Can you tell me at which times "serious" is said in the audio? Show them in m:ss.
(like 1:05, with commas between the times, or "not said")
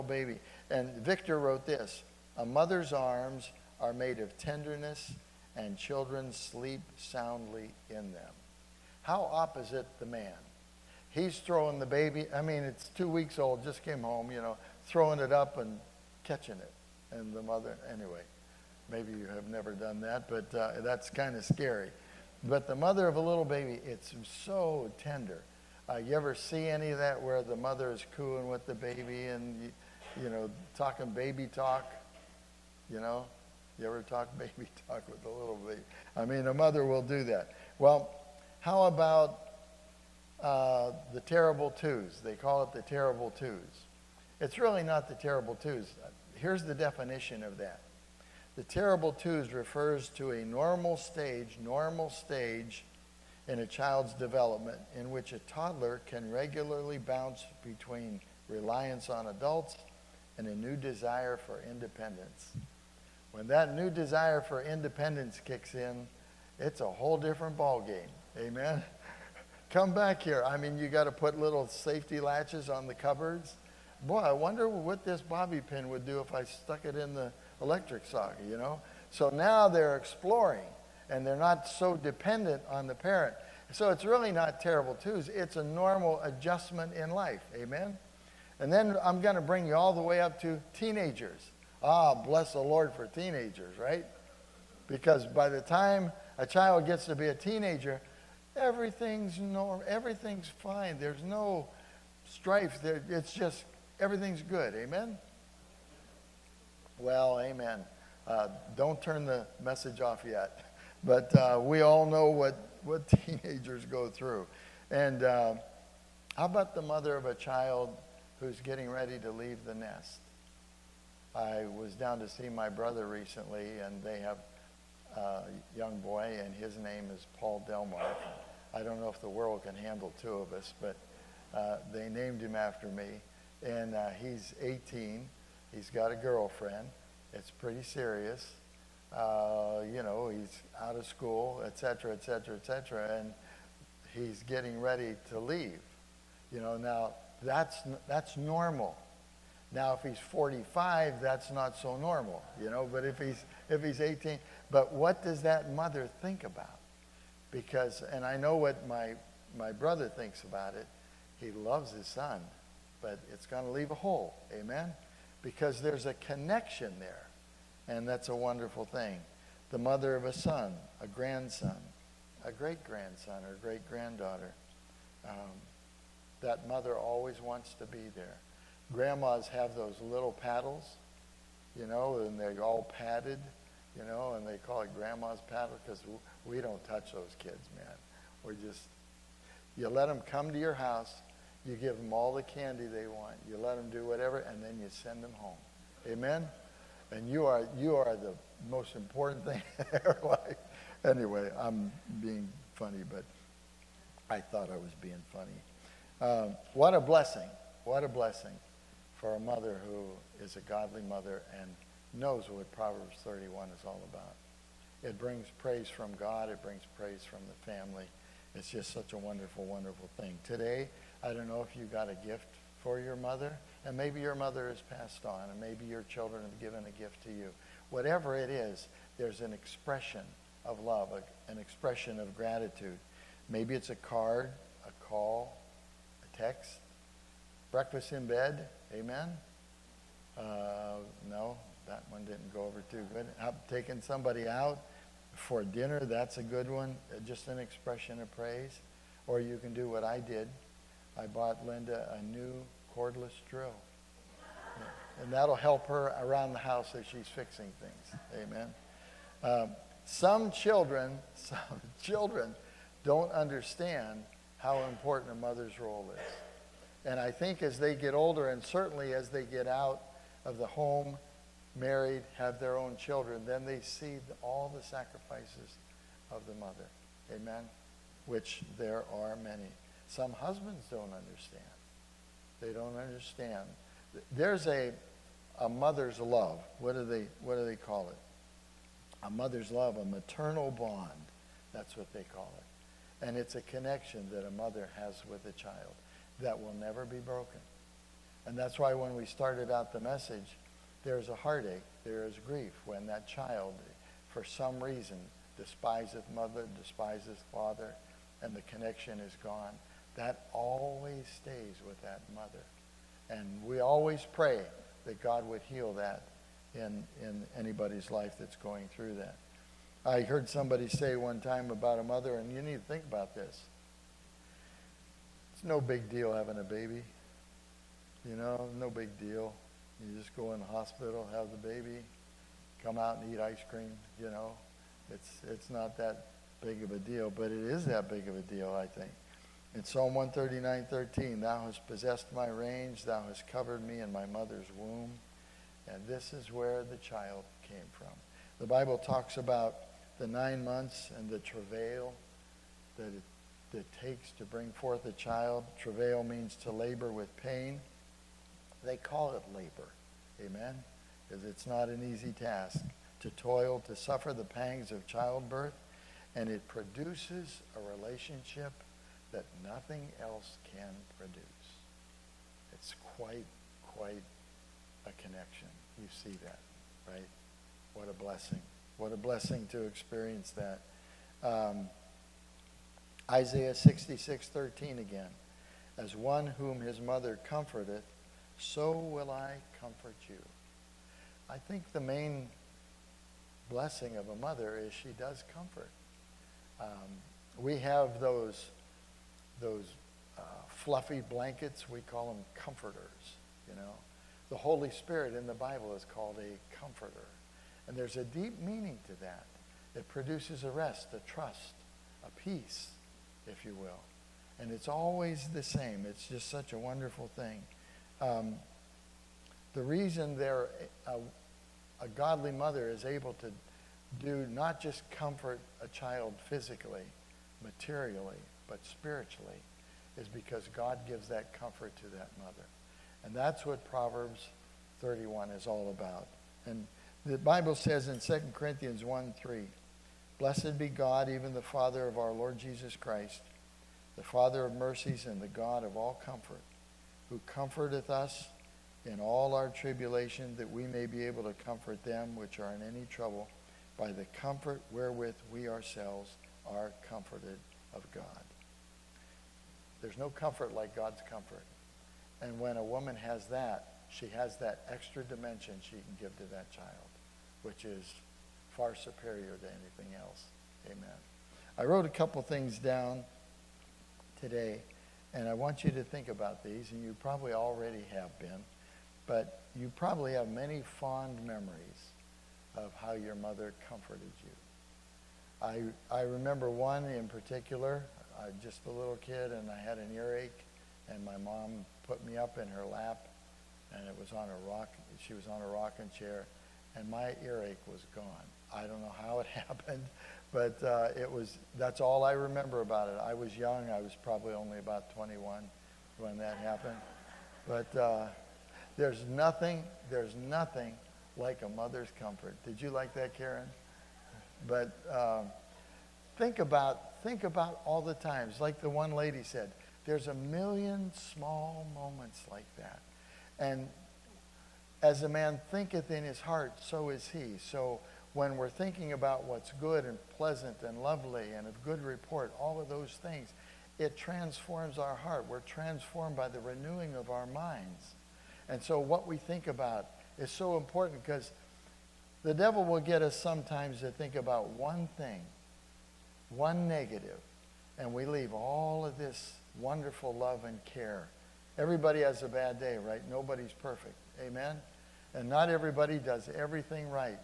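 2:17.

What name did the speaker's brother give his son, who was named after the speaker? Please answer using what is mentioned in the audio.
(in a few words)
Paul Delmark.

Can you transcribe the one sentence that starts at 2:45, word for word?
Because there's a connection there, and that's a wonderful thing.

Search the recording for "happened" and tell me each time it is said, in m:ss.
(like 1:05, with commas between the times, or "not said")
8:19, 8:26.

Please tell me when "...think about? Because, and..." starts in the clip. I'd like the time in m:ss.
2:36.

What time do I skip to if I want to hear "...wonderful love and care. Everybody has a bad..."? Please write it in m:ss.
9:09.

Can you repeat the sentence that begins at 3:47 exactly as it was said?
Whatever it is, there's an expression of love, an expression of gratitude.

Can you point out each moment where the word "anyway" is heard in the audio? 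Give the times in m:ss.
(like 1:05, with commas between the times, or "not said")
0:17, 3:21.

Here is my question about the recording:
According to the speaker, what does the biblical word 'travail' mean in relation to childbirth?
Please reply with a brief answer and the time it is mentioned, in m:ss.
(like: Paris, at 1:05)
To labor with pain, at 5:56.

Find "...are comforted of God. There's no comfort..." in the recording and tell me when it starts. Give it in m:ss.
7:36.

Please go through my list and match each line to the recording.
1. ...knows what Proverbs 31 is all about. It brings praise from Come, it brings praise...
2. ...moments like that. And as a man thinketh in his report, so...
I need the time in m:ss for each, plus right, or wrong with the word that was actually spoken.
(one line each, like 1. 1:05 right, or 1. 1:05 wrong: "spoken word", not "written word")
1. 3:32 wrong: "God", not "Come"
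2. 8:41 wrong: "heart", not "report".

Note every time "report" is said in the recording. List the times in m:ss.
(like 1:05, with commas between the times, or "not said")
8:52.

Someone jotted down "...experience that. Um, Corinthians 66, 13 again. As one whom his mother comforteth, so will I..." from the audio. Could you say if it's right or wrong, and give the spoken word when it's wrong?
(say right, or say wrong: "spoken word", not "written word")
wrong: "Isaiah", not "Corinthians".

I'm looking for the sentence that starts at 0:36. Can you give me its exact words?
I mean, a mother will do that.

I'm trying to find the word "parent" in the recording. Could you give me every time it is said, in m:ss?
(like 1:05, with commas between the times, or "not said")
1:22.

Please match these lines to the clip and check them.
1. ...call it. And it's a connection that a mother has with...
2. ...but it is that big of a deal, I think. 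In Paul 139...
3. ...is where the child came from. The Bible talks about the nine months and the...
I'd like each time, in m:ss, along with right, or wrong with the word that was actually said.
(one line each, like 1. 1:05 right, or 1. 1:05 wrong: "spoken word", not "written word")
1. 4:52 right
2. 5:37 wrong: "Psalm", not "Paul"
3. 5:46 right.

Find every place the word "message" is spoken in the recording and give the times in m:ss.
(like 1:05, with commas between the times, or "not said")
1:49, 4:59.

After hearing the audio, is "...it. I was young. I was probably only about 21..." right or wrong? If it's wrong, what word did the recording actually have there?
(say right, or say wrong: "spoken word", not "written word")
right.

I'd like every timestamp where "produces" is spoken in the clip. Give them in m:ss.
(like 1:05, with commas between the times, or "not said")
6:06, 6:11, 6:50.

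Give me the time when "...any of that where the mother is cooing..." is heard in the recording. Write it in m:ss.
0:26.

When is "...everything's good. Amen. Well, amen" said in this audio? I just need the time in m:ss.
1:43.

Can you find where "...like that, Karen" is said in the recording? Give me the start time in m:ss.
8:32.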